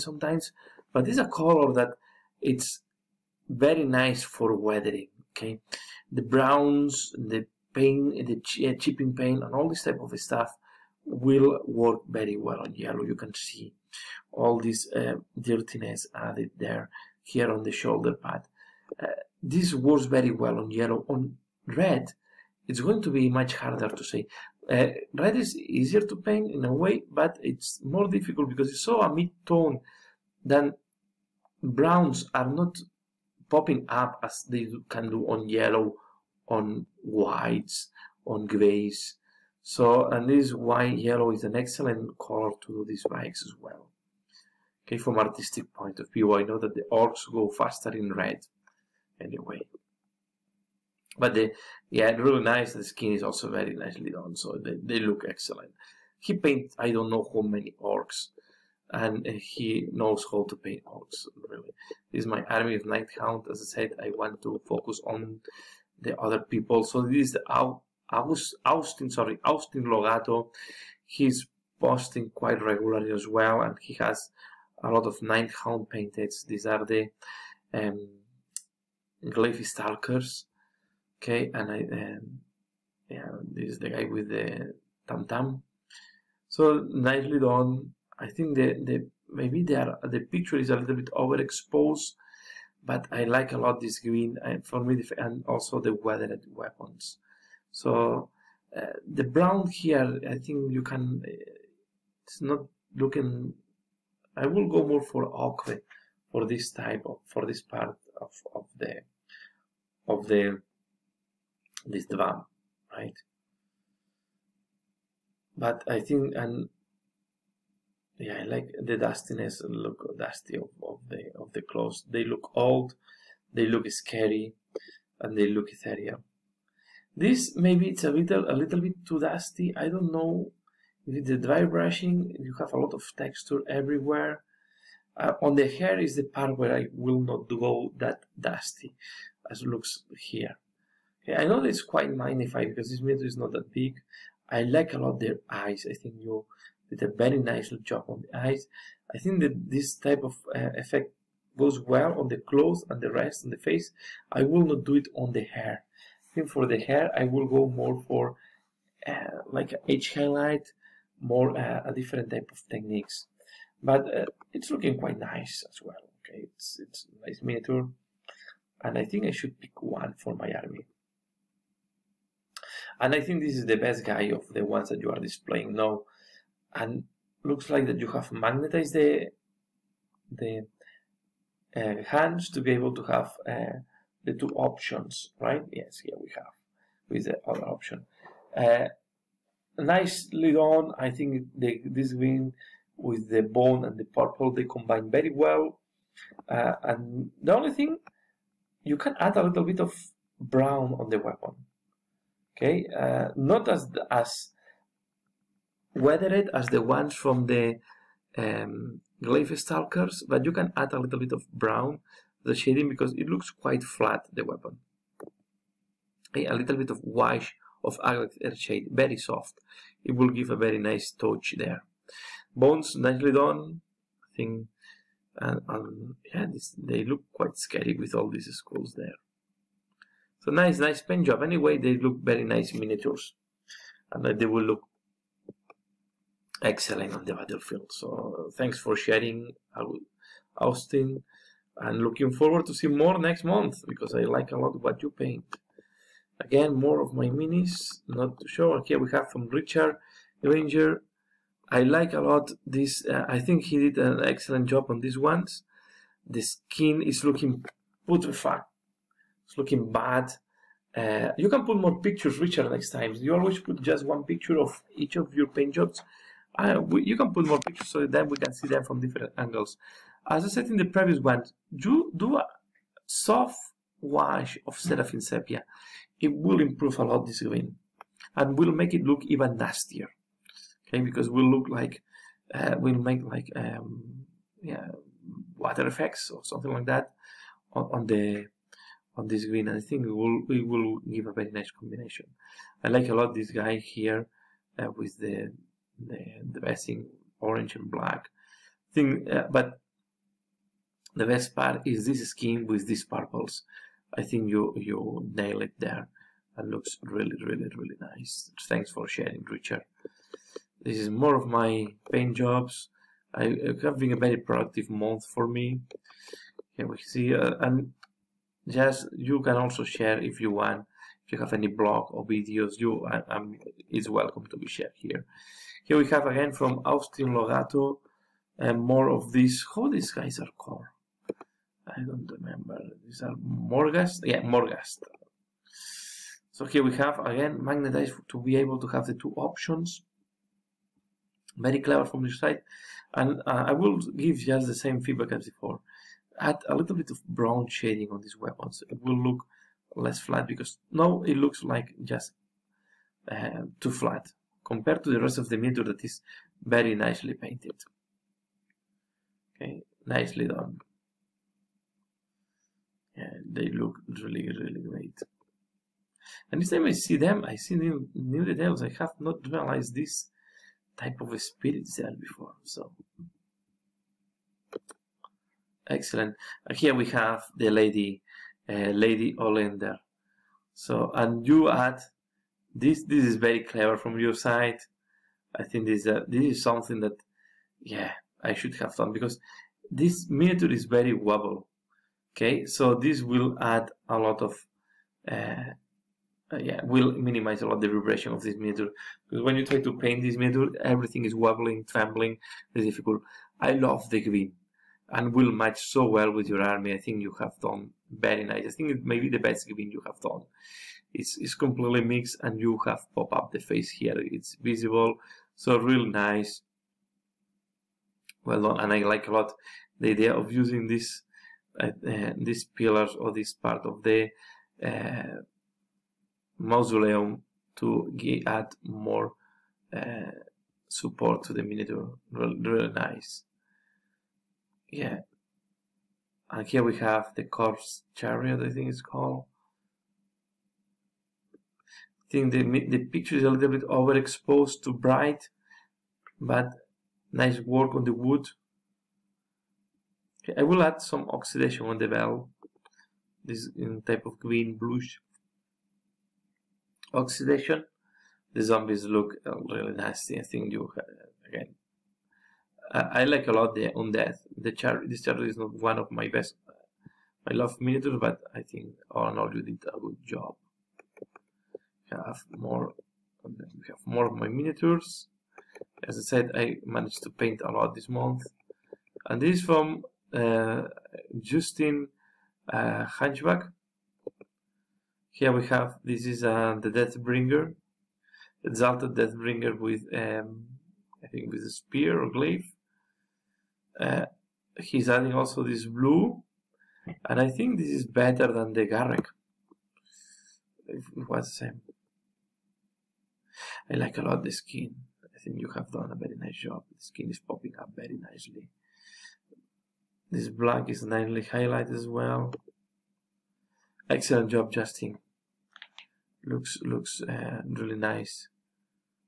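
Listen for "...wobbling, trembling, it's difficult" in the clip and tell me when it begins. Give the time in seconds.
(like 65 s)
401 s.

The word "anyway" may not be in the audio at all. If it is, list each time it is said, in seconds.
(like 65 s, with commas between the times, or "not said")
49 s, 231 s.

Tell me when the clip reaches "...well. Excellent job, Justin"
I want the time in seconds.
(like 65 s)
512 s.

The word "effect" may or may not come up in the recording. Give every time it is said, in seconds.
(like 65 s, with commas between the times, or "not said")
150 s, 285 s.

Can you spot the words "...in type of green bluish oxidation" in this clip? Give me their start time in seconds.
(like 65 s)
453 s.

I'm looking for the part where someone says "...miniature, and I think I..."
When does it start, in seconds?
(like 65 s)
167 s.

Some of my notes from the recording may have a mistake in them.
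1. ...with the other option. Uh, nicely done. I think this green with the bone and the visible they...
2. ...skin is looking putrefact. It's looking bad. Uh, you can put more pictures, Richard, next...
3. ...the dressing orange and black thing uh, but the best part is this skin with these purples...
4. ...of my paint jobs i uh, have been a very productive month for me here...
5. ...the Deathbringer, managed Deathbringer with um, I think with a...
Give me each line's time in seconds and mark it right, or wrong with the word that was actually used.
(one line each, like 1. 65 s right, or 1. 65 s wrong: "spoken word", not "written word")
1. 187 s wrong: "purple", not "visible"
2. 256 s right
3. 296 s right
4. 311 s right
5. 486 s wrong: "exalted", not "managed".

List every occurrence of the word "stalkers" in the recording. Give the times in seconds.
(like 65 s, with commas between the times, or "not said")
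79 s, 209 s.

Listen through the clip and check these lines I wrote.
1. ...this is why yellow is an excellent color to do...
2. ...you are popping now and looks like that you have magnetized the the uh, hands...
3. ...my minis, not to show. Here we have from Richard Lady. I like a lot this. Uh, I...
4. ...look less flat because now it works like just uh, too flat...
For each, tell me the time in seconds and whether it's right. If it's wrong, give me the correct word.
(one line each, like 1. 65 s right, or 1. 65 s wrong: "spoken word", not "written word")
1. 40 s right
2. 174 s wrong: "displaying", not "popping"
3. 247 s wrong: "Granger", not "Lady"
4. 349 s wrong: "looks", not "works".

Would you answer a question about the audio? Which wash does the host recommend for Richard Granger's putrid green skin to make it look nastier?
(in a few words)
Seraphim Sepia.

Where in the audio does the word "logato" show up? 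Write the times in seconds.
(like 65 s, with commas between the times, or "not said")
69 s, 327 s.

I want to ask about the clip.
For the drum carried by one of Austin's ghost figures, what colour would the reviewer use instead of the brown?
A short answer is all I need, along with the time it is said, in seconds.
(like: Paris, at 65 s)
Ochre, at 105 s.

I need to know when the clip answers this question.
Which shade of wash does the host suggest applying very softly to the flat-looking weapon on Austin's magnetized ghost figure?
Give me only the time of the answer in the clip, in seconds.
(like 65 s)
218 s.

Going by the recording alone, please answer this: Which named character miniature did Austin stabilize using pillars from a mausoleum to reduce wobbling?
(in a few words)
Lady Olynder.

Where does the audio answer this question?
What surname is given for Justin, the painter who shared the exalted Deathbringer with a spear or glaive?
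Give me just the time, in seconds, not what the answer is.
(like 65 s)
483 s.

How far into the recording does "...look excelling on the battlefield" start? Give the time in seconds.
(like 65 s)
234 s.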